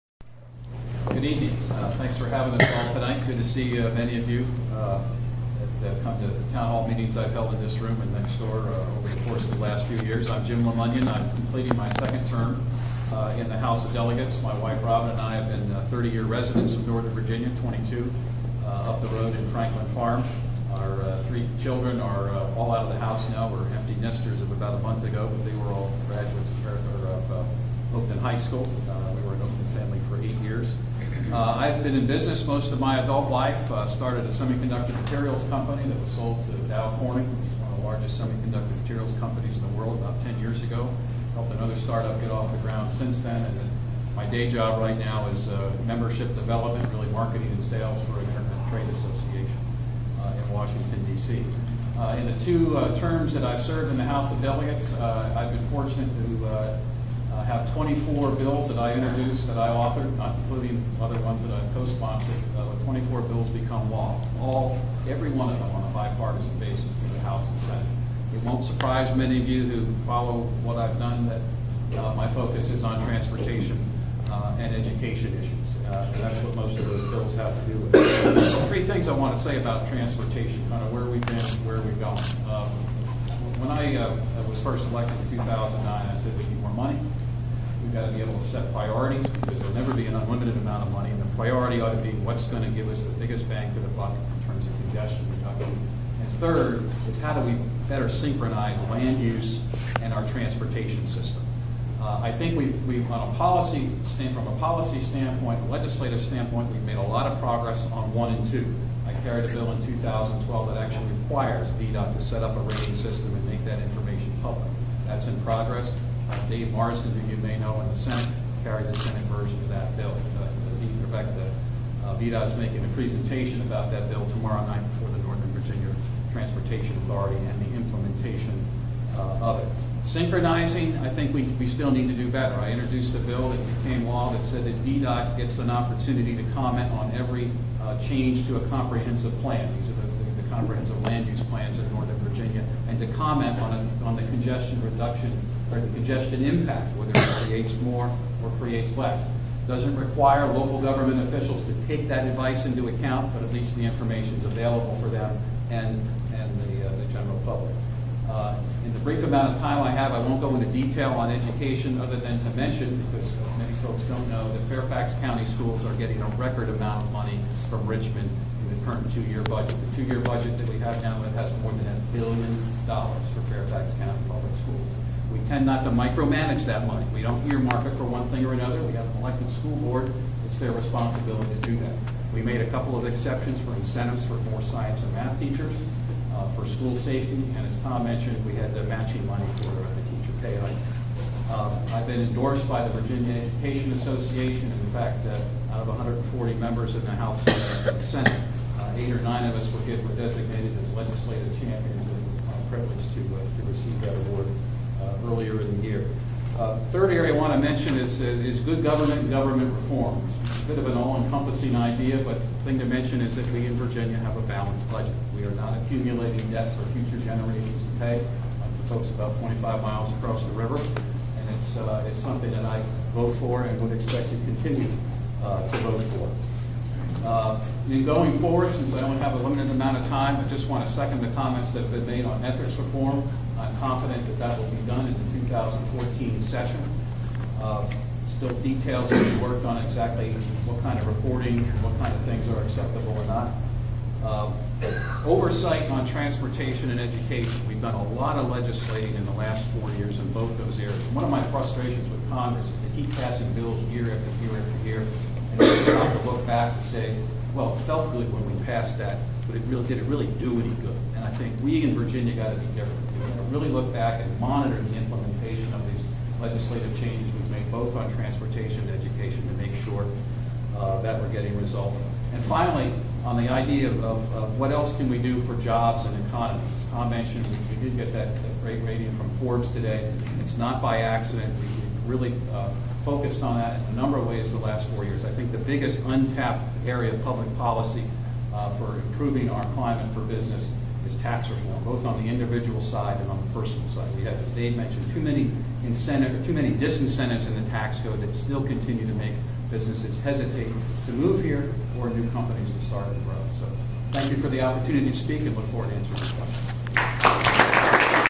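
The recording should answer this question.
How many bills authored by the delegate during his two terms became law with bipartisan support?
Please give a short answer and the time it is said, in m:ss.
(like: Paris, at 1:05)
24, at 1:02.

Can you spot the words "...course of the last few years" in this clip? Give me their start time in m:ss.
0:09.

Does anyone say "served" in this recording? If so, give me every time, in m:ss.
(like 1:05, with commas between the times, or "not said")
0:53.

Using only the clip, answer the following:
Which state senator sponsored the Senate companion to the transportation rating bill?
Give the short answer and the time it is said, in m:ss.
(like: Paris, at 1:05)
Dave Marsden, at 1:56.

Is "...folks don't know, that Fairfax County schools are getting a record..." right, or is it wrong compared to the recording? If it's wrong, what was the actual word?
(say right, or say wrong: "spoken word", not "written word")
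right.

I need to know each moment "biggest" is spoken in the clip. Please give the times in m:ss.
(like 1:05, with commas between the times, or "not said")
1:33, 4:45.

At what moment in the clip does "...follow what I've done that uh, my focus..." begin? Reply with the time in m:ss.
1:10.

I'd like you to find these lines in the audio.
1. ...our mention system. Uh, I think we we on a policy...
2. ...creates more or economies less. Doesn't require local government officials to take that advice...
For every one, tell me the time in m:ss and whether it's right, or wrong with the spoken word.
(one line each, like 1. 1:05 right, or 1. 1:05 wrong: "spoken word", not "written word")
1. 1:40 wrong: "transportation", not "mention"
2. 2:27 wrong: "creates", not "economies".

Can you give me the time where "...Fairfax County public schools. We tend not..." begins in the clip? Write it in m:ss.
2:53.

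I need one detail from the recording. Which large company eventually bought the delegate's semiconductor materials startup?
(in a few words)
Dow Corning.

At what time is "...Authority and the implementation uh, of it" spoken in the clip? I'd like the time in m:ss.
2:07.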